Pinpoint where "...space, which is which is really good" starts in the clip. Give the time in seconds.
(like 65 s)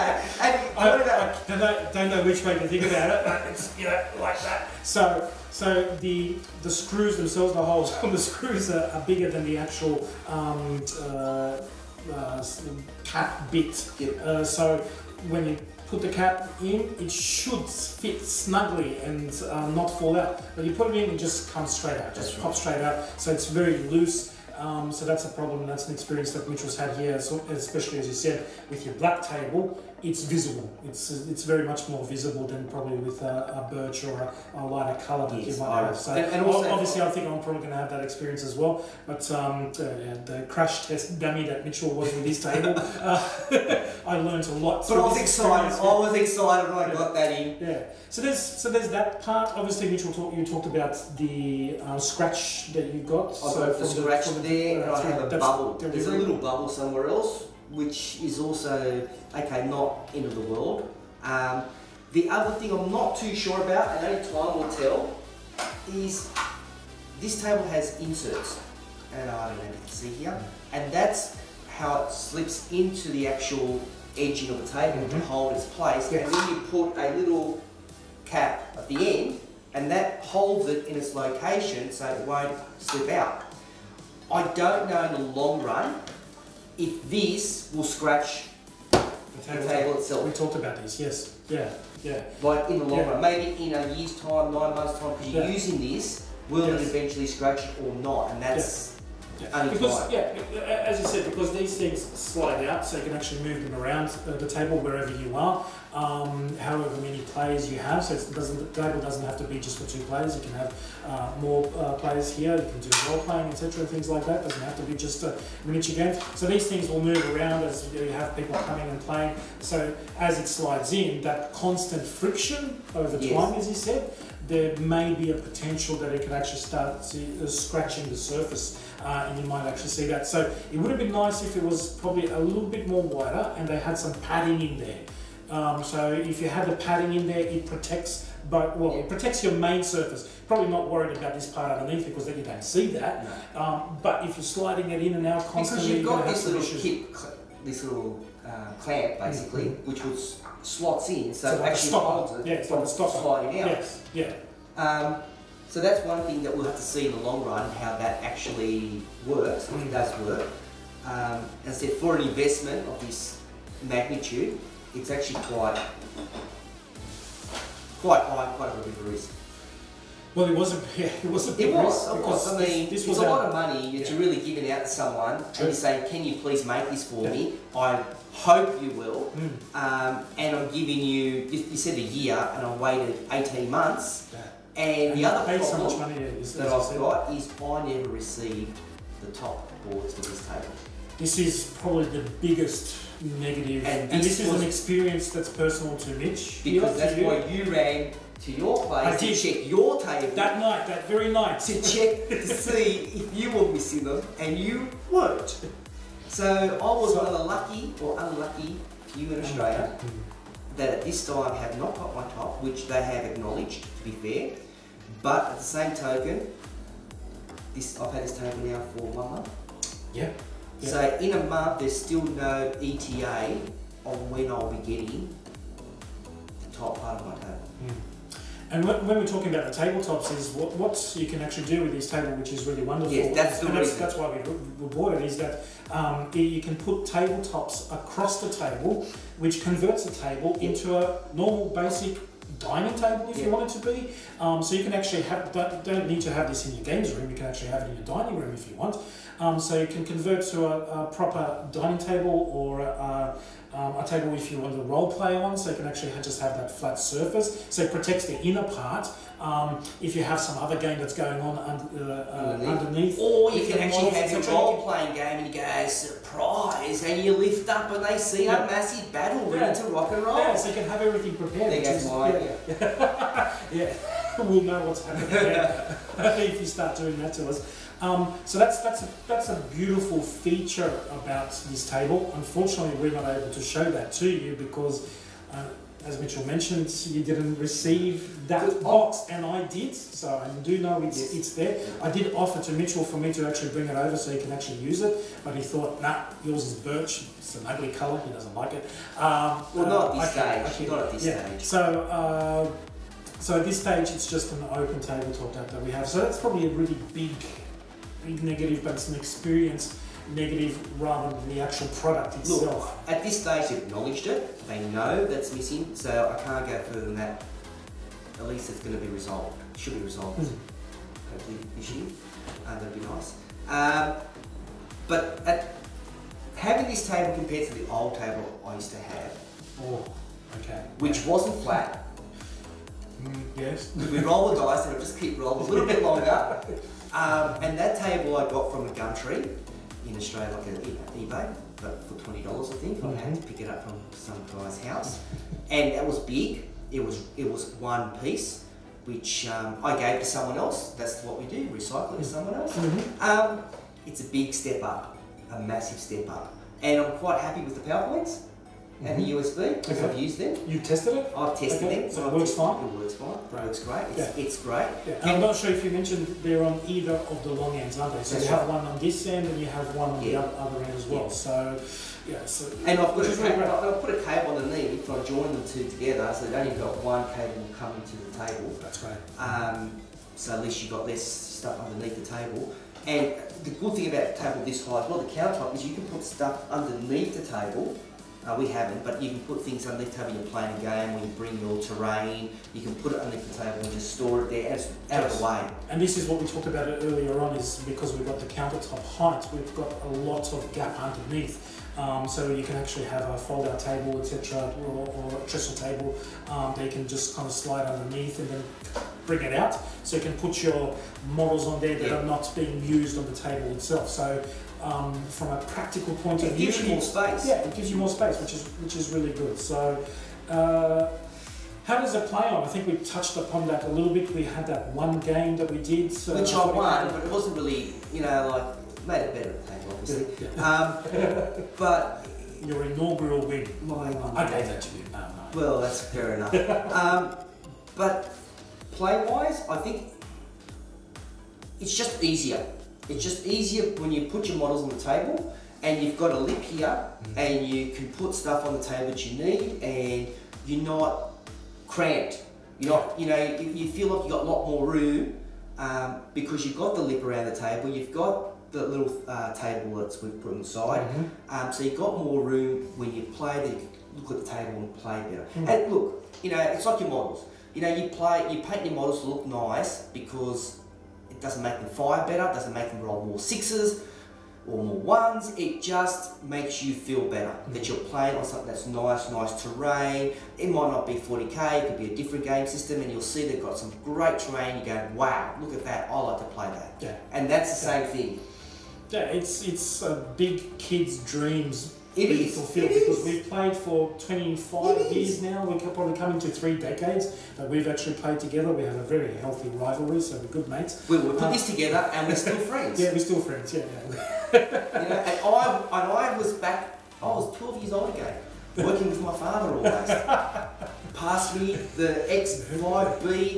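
418 s.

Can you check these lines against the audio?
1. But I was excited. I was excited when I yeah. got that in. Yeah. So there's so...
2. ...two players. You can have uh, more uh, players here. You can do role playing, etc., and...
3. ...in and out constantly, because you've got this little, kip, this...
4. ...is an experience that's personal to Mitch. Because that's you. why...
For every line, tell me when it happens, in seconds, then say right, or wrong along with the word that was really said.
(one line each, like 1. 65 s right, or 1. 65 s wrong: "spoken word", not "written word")
1. 44 s right
2. 109 s right
3. 145 s right
4. 194 s right.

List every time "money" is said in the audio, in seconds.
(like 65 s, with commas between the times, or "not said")
173 s, 185 s.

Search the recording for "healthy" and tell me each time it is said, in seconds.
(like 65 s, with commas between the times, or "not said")
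499 s.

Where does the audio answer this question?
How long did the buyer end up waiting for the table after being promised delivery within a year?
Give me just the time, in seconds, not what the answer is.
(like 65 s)
183 s.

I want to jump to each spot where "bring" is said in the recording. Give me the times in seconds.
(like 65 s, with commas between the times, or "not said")
293 s, 391 s, 409 s.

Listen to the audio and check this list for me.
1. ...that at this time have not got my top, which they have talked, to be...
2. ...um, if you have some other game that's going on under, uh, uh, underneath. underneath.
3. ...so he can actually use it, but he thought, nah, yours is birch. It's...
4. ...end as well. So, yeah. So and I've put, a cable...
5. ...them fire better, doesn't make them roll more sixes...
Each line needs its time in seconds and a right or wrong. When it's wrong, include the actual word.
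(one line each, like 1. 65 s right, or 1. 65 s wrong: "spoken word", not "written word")
1. 210 s wrong: "acknowledged", not "talked"
2. 259 s right
3. 294 s right
4. 370 s right
5. 471 s right.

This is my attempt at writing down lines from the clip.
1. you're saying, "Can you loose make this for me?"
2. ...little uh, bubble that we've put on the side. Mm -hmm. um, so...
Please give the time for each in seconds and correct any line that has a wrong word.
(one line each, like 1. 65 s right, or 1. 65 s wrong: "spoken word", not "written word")
1. 175 s wrong: "please", not "loose"
2. 458 s wrong: "table", not "bubble".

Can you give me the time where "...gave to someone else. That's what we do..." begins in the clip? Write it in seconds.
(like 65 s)
349 s.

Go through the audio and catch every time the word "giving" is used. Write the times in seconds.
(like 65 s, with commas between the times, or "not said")
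174 s, 180 s.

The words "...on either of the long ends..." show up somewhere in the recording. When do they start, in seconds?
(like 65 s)
366 s.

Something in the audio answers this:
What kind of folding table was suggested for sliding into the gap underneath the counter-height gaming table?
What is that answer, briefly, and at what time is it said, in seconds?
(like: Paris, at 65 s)
Trestle table, at 405 s.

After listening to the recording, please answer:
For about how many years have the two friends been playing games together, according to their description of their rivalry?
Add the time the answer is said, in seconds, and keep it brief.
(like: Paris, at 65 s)
25, at 494 s.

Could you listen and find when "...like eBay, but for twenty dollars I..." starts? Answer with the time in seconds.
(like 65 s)
340 s.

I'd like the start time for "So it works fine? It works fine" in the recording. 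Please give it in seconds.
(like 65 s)
362 s.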